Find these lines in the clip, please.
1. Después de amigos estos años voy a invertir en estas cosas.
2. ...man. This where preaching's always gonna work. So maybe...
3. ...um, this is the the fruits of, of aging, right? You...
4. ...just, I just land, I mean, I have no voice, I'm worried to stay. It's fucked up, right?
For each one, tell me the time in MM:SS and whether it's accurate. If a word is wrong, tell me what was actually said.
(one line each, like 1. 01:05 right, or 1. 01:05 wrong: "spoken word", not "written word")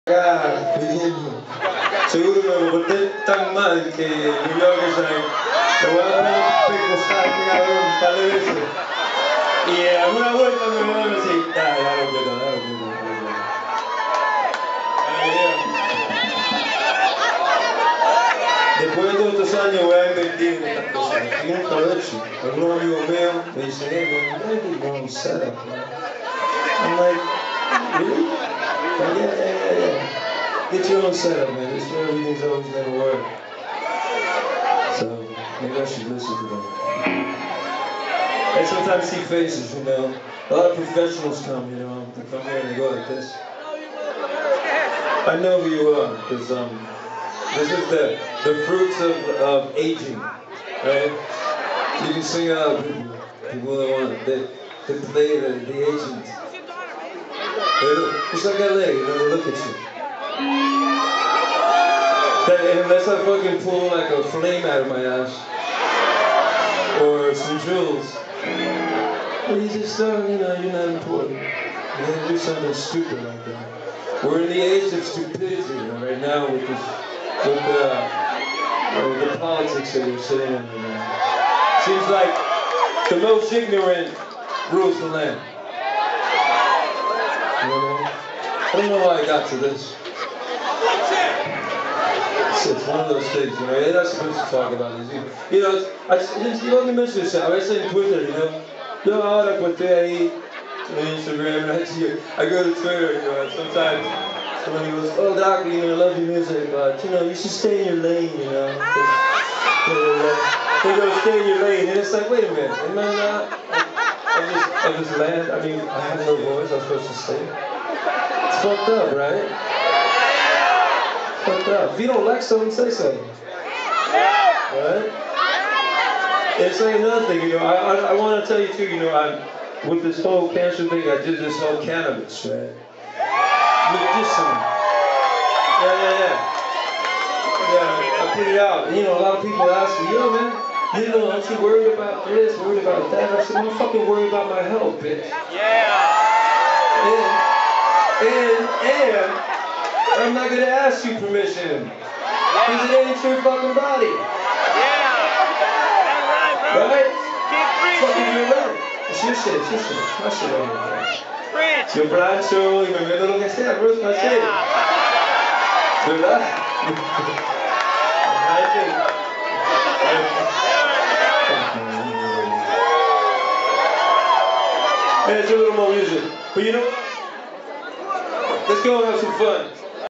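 1. 00:18 wrong: "todos", not "amigos"
2. 00:31 wrong: "everything", not "preaching"
3. 00:46 right
4. 01:54 wrong: "supposed", not "worried".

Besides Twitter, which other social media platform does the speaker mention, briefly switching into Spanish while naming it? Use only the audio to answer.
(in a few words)
Instagram.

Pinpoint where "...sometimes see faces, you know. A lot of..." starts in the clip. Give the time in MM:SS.
00:38.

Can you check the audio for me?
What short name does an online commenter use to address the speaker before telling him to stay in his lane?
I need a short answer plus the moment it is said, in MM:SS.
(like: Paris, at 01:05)
Doc, at 01:45.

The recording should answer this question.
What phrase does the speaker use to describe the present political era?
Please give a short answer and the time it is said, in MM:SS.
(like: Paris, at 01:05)
The age of stupidity, at 01:14.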